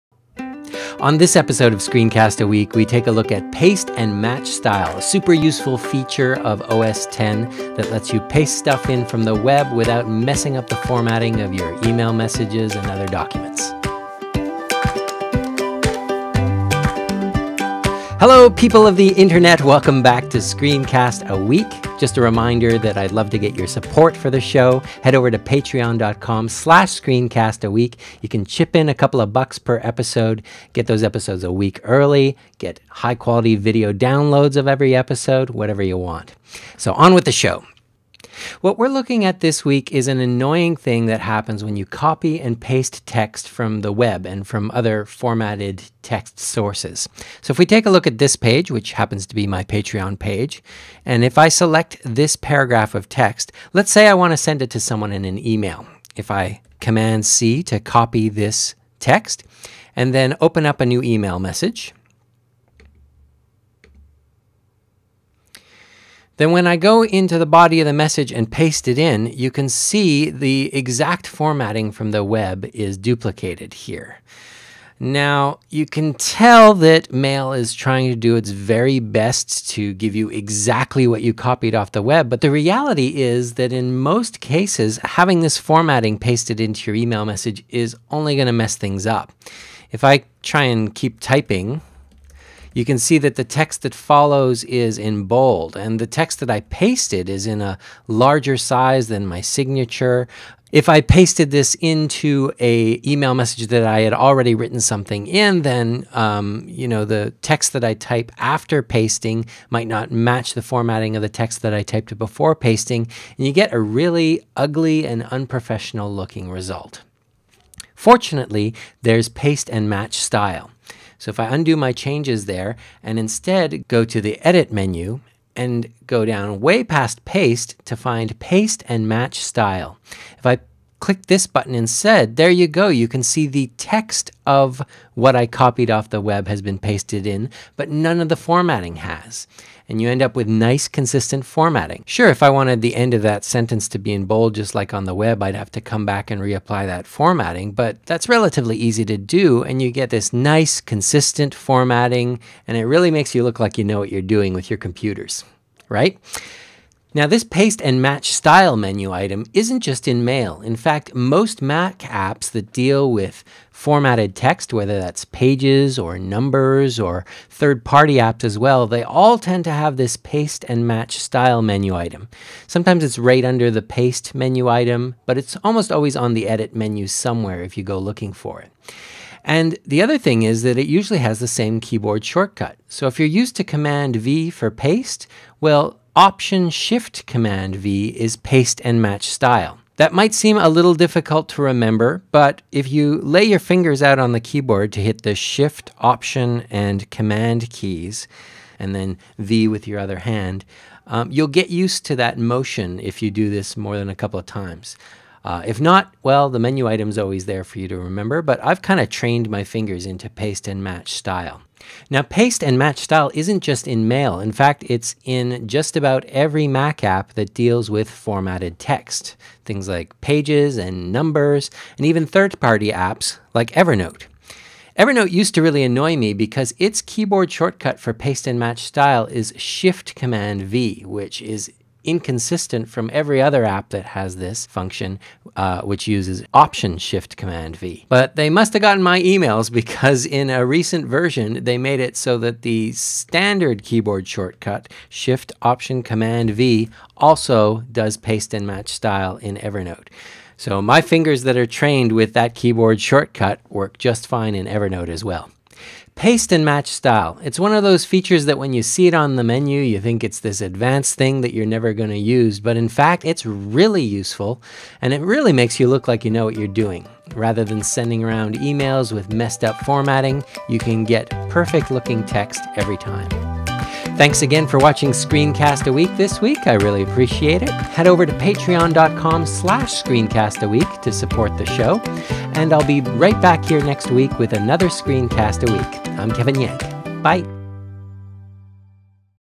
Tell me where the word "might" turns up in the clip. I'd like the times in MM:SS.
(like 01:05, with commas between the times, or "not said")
01:49, 03:10.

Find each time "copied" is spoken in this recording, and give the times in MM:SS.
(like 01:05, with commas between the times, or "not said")
01:21, 02:15.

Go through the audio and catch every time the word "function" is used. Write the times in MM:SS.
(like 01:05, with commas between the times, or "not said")
03:54.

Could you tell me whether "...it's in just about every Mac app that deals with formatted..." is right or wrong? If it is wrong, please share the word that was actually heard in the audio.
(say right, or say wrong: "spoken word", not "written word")
right.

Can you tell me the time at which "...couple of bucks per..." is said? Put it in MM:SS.
00:28.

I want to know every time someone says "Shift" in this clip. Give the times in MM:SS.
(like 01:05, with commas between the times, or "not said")
03:06, 03:15, 03:49, 03:56, 04:05.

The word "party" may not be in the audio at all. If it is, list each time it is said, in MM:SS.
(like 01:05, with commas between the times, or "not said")
02:47, 03:42.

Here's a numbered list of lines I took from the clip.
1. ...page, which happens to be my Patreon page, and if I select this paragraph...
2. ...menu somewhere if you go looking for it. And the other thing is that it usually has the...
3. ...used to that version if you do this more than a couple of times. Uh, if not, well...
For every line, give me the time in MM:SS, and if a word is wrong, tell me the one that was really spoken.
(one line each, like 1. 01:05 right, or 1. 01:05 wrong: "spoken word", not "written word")
1. 00:48 right
2. 02:56 right
3. 03:21 wrong: "motion", not "version".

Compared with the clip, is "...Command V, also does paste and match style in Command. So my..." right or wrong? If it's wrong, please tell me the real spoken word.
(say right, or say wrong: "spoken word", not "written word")
wrong: "Evernote", not "Command".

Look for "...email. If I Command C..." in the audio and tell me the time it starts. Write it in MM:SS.
00:55.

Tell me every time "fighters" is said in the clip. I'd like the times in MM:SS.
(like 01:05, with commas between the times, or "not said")
not said.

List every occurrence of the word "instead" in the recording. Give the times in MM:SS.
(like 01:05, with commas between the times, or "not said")
02:03, 02:11.